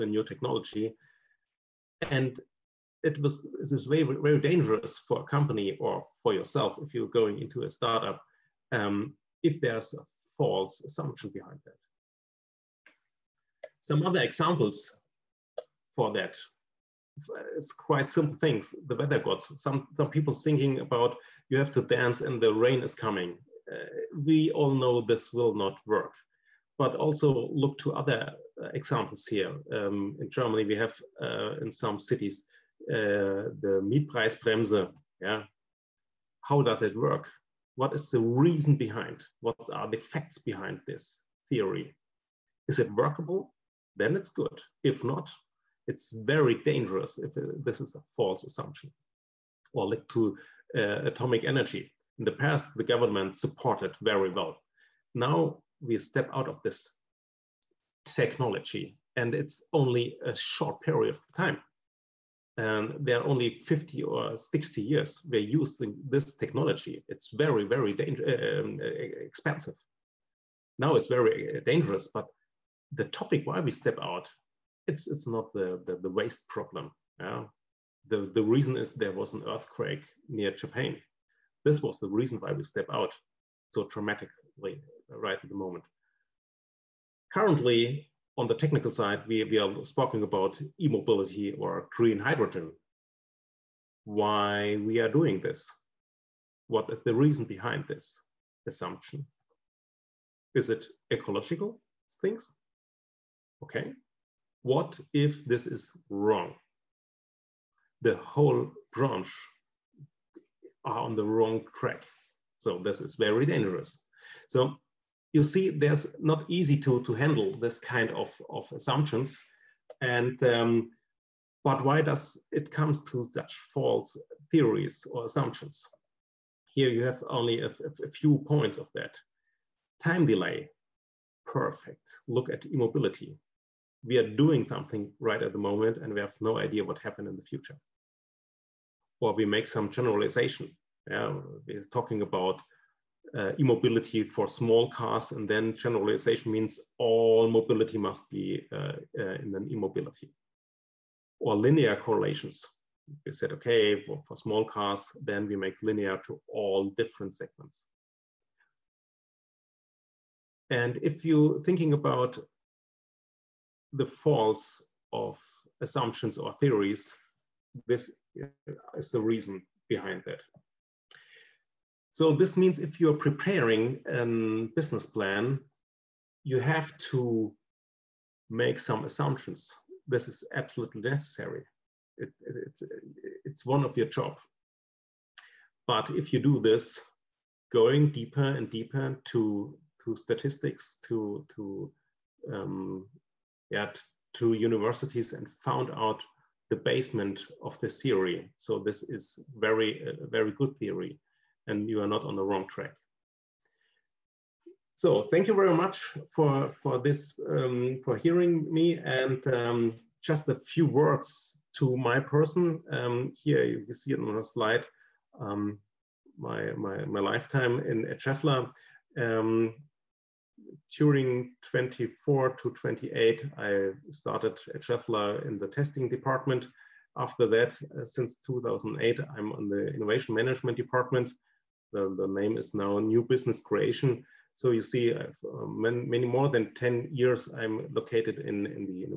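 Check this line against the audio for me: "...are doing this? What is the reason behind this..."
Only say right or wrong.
right.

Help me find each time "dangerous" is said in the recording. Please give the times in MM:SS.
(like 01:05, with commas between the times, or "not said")
00:04, 00:46, 01:11, 01:53.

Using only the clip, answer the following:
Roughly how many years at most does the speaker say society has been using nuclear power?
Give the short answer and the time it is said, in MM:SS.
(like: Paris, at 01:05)
50 or 60 years, at 01:03.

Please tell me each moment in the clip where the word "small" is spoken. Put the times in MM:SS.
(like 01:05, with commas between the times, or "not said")
02:24, 02:34.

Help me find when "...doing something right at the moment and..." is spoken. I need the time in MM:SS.
02:14.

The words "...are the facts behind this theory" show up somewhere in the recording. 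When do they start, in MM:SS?
00:39.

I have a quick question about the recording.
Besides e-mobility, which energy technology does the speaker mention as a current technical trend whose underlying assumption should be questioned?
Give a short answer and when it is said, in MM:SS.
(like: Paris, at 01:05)
green hydrogen, at 01:31.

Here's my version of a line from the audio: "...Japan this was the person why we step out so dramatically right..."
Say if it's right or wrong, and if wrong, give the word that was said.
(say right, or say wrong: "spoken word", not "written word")
wrong: "reason", not "person".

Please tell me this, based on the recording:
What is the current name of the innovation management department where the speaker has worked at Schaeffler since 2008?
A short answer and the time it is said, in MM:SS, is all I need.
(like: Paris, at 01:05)
New Business Creation, at 03:52.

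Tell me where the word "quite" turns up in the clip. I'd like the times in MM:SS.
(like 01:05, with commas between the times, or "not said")
00:17.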